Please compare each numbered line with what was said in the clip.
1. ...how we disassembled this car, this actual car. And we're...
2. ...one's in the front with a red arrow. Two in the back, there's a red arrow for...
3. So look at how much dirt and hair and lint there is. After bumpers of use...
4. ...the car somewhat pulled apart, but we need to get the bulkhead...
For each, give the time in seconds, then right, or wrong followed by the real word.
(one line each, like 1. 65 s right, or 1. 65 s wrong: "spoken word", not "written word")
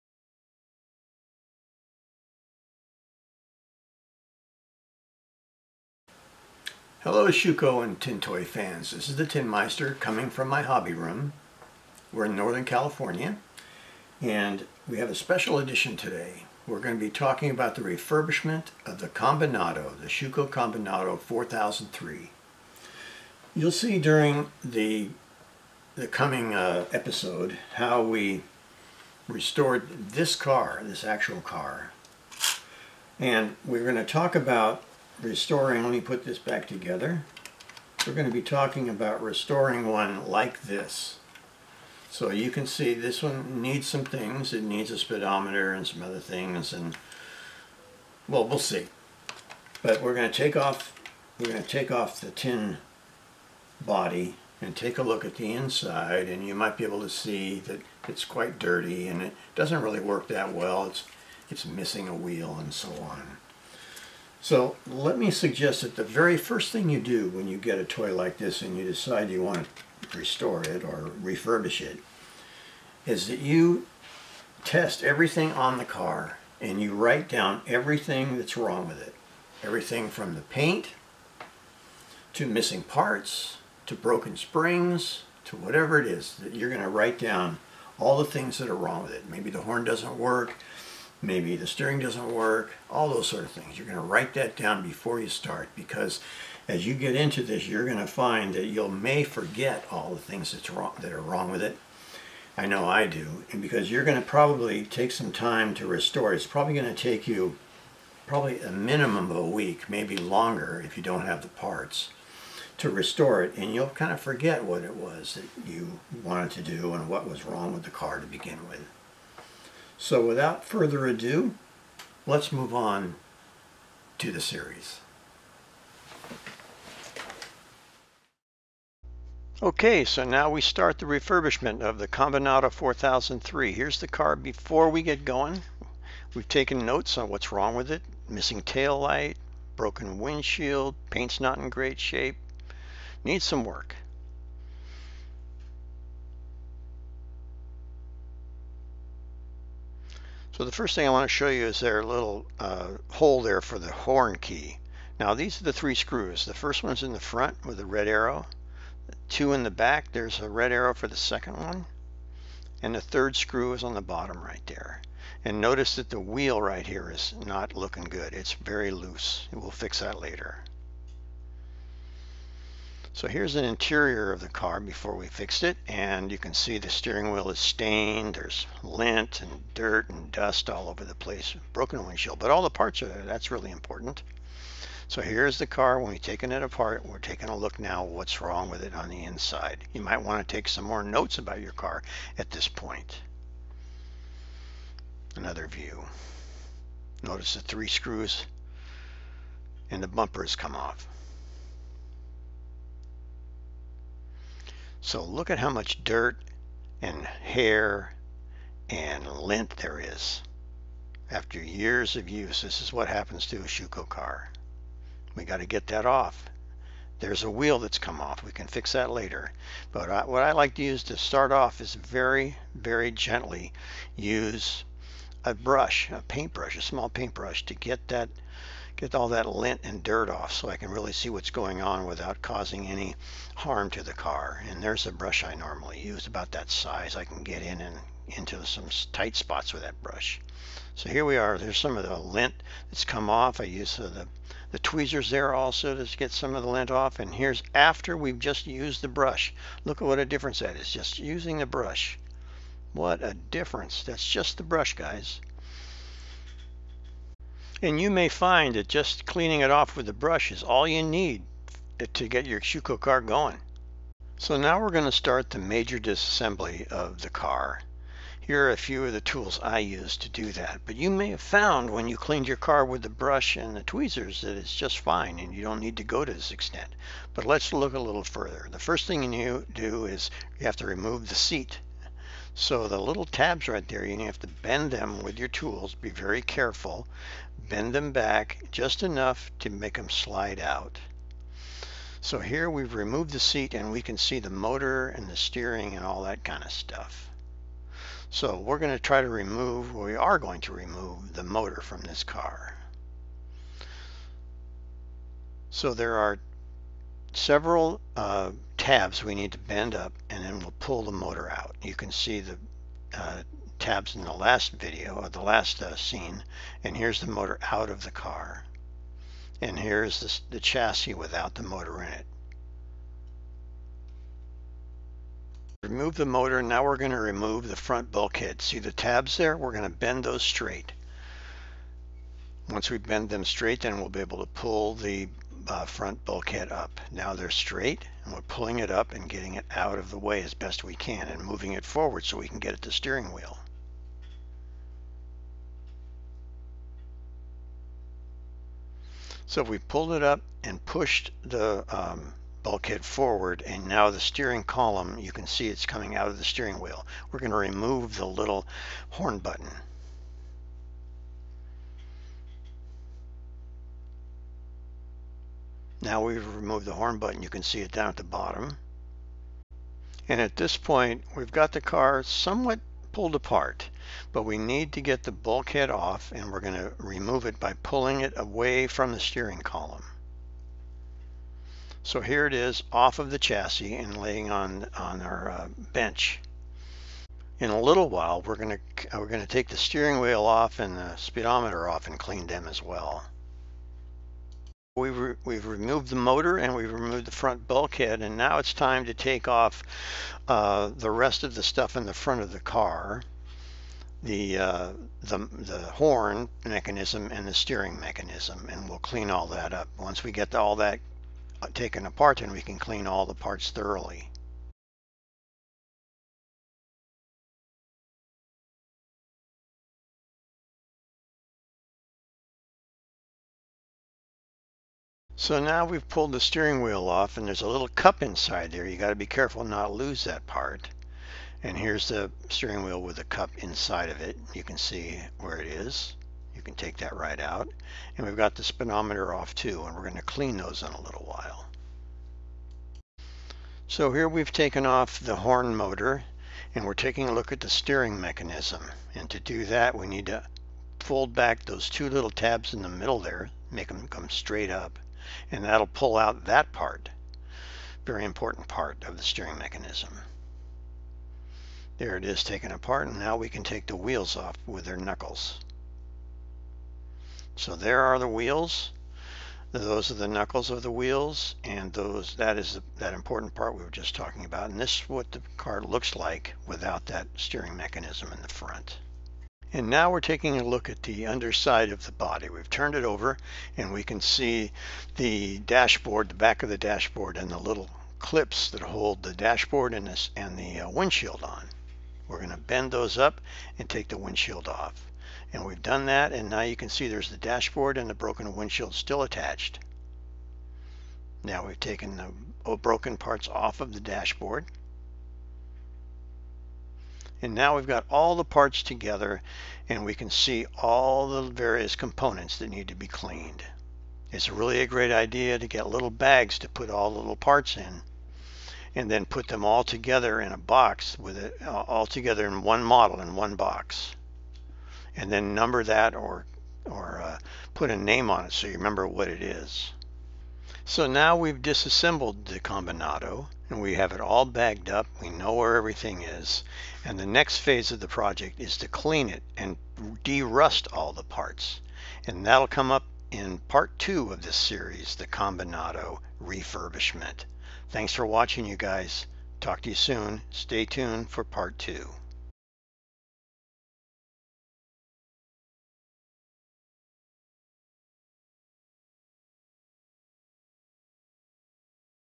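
1. 27 s wrong: "restored", not "disassembled"
2. 156 s right
3. 205 s wrong: "years", not "bumpers"
4. 371 s right.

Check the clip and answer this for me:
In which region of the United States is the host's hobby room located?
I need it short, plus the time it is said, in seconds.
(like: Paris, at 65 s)
Northern California, at 12 s.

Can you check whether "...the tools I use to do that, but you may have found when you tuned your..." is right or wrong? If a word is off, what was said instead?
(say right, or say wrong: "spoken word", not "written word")
wrong: "cleaned", not "tuned".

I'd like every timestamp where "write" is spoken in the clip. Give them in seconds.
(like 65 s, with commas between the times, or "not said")
76 s, 86 s, 94 s.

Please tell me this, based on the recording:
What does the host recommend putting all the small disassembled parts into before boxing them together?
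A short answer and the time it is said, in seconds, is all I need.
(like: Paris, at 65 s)
Little bags, at 515 s.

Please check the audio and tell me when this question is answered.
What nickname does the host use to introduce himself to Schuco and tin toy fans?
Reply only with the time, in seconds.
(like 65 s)
9 s.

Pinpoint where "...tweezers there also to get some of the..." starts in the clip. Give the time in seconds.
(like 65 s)
244 s.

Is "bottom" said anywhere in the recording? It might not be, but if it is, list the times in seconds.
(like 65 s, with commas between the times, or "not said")
164 s, 368 s.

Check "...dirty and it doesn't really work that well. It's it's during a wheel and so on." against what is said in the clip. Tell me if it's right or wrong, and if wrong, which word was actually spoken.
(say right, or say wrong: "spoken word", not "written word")
wrong: "missing", not "during".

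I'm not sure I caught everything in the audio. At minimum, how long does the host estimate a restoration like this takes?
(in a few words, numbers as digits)
A week.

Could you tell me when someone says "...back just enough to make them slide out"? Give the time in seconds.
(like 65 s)
288 s.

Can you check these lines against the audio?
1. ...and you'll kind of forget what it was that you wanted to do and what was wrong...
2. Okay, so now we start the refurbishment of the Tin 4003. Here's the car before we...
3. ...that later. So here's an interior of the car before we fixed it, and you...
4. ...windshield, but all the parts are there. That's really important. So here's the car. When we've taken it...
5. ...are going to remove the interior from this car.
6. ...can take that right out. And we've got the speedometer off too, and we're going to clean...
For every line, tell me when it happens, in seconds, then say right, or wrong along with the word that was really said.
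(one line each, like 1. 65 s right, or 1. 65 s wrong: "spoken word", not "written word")
1. 113 s right
2. 129 s wrong: "Combinato", not "Tin"
3. 170 s right
4. 182 s right
5. 300 s wrong: "motor", not "interior"
6. 436 s right.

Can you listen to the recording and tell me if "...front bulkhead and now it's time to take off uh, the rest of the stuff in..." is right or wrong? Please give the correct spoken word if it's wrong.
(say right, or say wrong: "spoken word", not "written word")
right.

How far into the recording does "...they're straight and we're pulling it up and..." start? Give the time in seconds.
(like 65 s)
337 s.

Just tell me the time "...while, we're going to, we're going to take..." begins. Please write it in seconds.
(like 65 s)
388 s.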